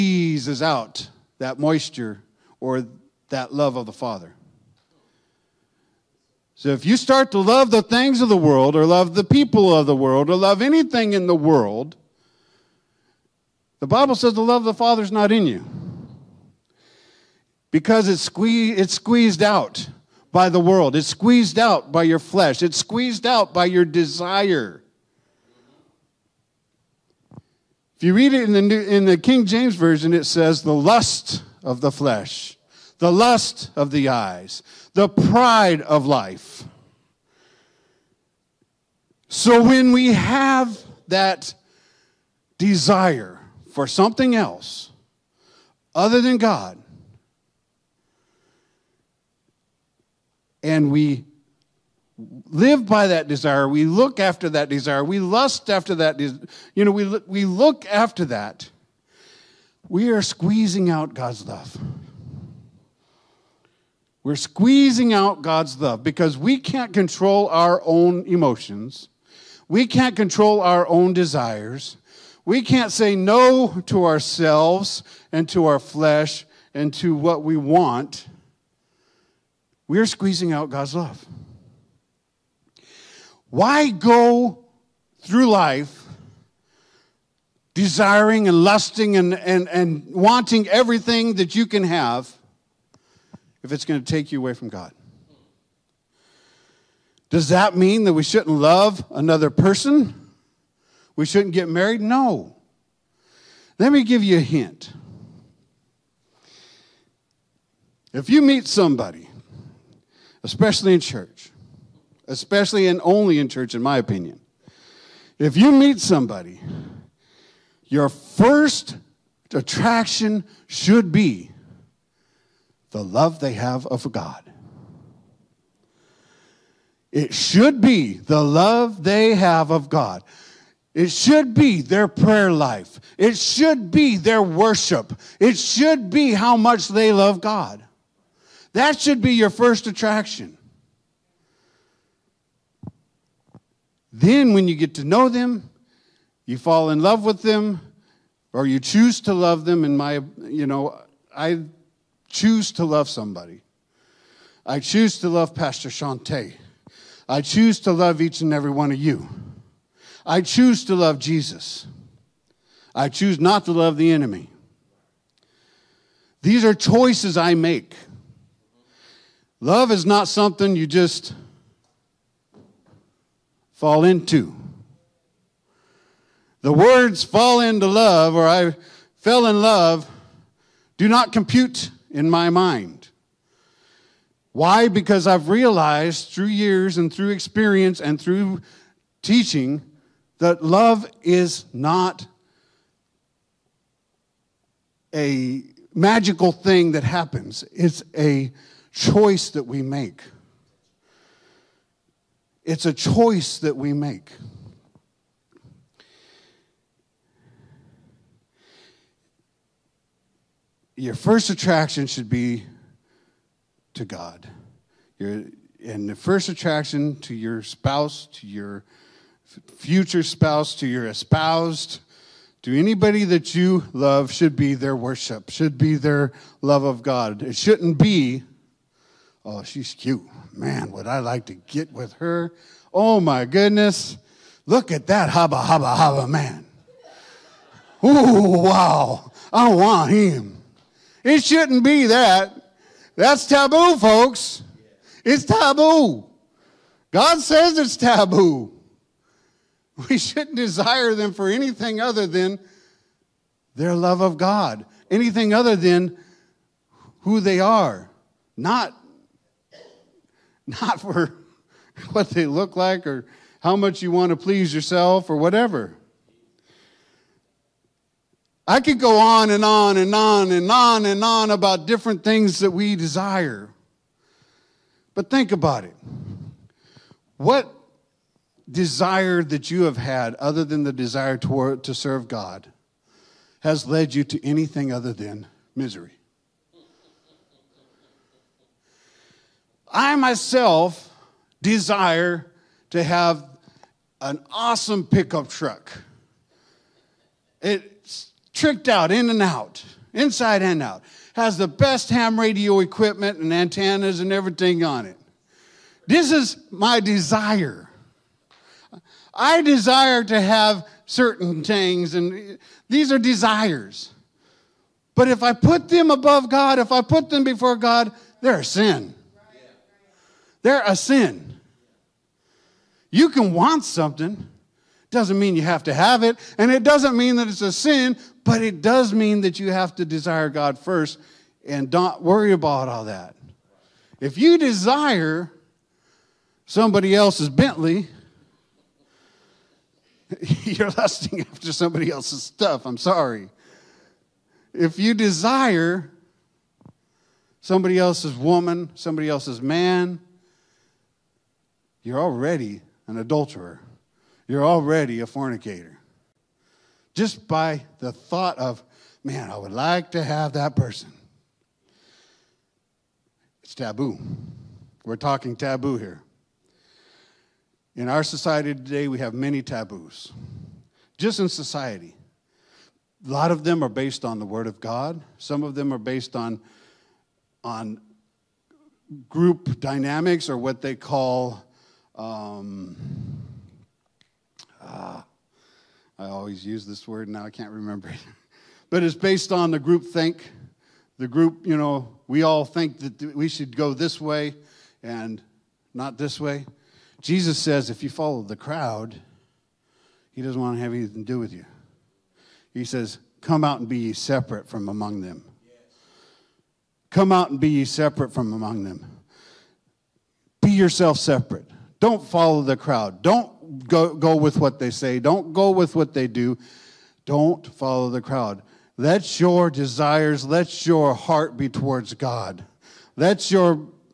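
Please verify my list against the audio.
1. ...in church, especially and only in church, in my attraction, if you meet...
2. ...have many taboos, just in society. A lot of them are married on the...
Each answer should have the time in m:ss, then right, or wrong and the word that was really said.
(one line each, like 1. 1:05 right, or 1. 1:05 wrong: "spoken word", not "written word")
1. 1:50 wrong: "opinion", not "attraction"
2. 6:09 wrong: "based", not "married".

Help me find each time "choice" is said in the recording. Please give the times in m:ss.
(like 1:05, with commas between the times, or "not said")
2:46, 3:18, 3:22.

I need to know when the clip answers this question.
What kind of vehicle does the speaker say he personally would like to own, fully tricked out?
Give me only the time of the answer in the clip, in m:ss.
4:55.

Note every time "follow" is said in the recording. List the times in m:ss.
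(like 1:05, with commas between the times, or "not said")
6:38, 6:52, 6:57.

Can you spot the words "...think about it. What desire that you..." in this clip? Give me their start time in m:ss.
4:35.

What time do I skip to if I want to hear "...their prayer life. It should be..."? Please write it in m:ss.
2:11.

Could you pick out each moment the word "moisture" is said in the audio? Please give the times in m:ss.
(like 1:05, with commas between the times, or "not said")
0:01.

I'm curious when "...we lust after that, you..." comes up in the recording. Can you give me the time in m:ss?
0:55.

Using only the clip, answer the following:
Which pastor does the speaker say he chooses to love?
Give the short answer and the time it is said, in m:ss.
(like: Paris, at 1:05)
Pastor Shante, at 2:35.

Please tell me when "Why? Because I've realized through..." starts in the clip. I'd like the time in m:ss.
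3:04.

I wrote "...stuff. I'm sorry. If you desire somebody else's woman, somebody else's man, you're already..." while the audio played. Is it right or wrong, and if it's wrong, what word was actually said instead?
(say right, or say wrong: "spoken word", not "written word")
right.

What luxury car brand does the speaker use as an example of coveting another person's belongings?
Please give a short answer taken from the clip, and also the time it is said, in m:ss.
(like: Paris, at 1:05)
Bentley, at 5:37.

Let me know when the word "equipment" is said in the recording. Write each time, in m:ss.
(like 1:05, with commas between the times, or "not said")
5:02.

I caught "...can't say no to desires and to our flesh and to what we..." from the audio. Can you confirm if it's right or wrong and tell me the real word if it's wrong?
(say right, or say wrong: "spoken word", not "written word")
wrong: "ourselves", not "desires".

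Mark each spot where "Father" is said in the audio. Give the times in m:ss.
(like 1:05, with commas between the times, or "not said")
0:03, 0:14.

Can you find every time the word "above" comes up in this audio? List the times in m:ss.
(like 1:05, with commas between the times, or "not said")
5:16.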